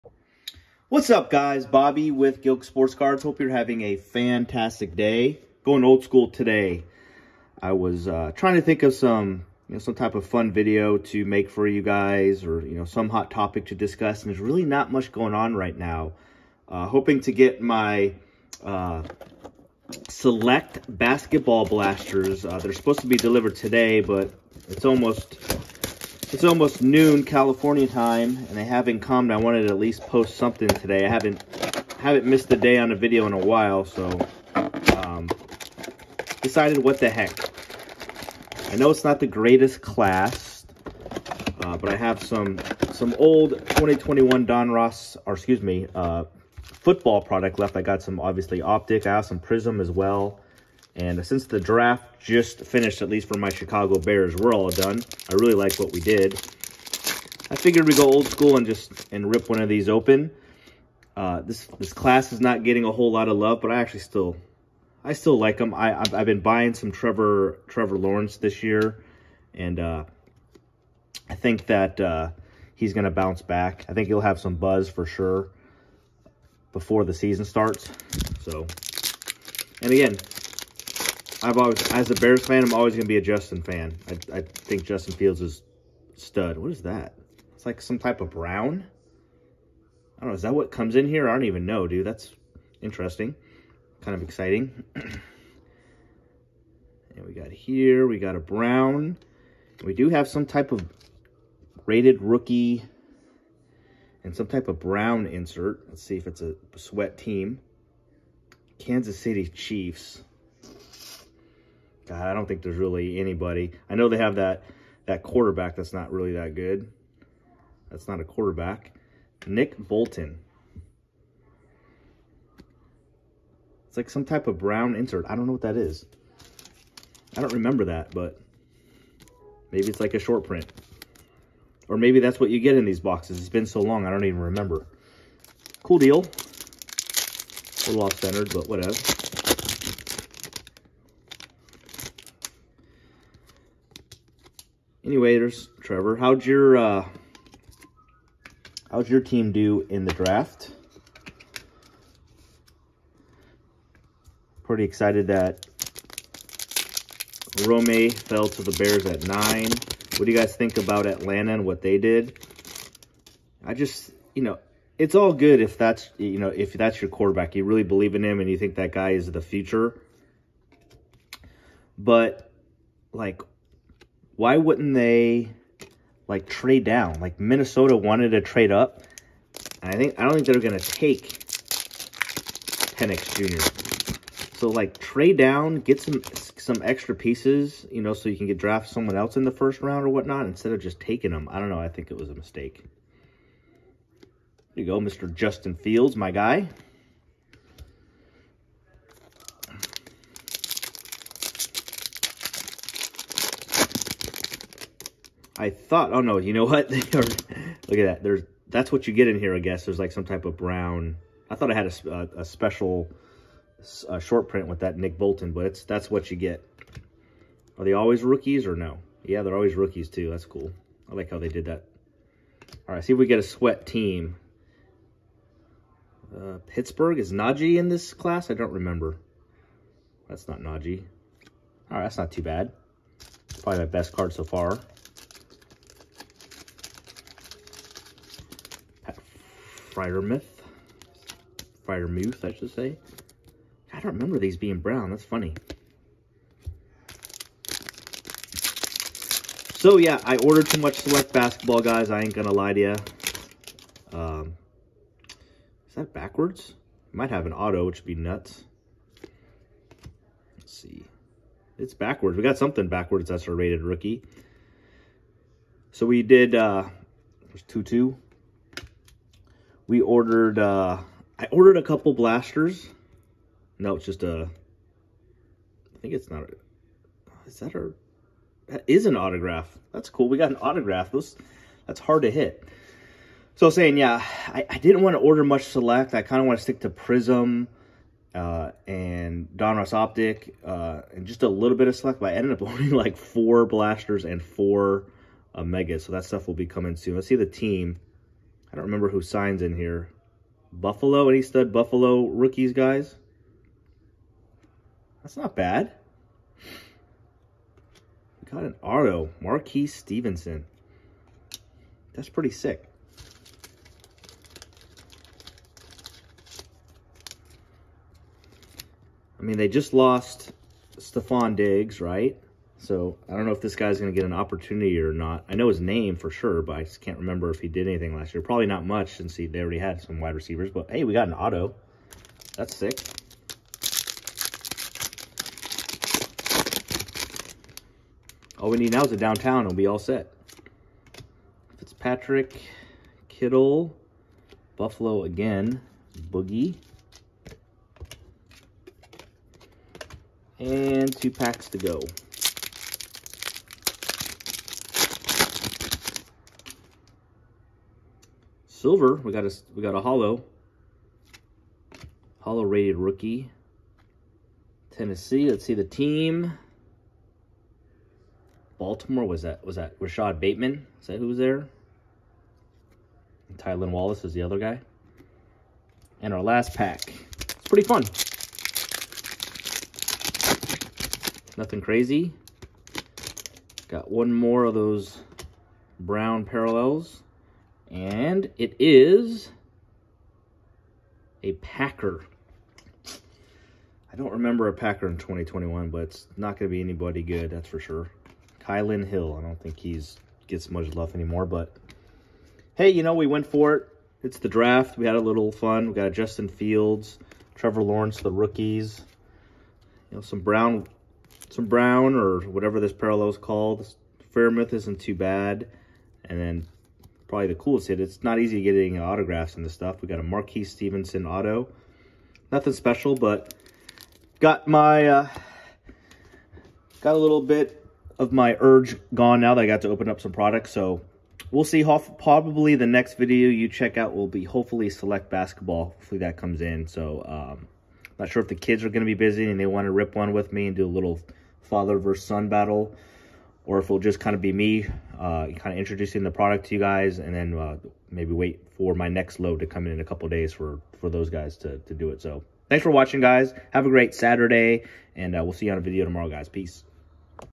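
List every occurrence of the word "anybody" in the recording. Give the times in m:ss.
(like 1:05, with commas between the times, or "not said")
1:53, 6:36.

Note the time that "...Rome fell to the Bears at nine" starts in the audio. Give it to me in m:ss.
2:37.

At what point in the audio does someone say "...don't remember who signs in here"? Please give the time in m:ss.
4:58.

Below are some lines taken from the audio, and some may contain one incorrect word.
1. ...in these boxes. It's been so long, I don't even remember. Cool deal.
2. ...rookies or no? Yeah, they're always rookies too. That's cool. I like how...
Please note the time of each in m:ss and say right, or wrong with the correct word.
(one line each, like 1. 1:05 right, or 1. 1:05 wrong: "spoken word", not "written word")
1. 2:12 right
2. 3:38 right.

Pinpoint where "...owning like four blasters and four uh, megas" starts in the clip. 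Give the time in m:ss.
4:52.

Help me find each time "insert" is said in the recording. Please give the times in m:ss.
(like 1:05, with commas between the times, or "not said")
1:45, 2:04.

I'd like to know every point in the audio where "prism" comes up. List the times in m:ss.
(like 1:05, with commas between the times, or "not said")
0:49, 4:46.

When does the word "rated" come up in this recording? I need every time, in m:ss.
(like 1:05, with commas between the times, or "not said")
1:41, 4:23, 6:02.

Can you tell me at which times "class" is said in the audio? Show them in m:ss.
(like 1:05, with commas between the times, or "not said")
0:39, 1:01, 3:48.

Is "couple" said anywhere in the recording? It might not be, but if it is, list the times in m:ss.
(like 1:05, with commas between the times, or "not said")
4:31, 7:30.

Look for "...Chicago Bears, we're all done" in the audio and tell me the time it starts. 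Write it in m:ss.
0:53.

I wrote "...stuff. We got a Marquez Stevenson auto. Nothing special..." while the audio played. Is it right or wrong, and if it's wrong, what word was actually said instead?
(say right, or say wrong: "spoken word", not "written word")
right.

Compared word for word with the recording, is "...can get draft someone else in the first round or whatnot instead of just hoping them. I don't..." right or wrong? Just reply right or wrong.
wrong.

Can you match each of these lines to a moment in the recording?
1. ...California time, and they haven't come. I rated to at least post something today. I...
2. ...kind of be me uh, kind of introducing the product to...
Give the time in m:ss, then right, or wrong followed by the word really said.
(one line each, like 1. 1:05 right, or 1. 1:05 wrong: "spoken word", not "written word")
1. 0:27 wrong: "wanted", not "rated"
2. 7:24 right.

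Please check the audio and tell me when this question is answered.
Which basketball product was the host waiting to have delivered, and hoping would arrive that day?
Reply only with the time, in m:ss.
0:20.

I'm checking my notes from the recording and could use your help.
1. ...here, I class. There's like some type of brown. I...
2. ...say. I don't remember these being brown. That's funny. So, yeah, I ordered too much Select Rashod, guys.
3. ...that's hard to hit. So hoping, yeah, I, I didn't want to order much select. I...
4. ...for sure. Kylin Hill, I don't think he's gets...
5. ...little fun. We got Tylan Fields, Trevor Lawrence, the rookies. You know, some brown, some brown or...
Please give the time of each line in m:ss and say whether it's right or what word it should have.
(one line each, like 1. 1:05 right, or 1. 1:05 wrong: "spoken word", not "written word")
1. 3:29 wrong: "guess", not "class"
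2. 4:02 wrong: "Basketball", not "Rashod"
3. 4:41 wrong: "saying", not "hoping"
4. 6:37 right
5. 6:45 wrong: "Justin", not "Tylan".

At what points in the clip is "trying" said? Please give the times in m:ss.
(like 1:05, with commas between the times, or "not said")
0:08.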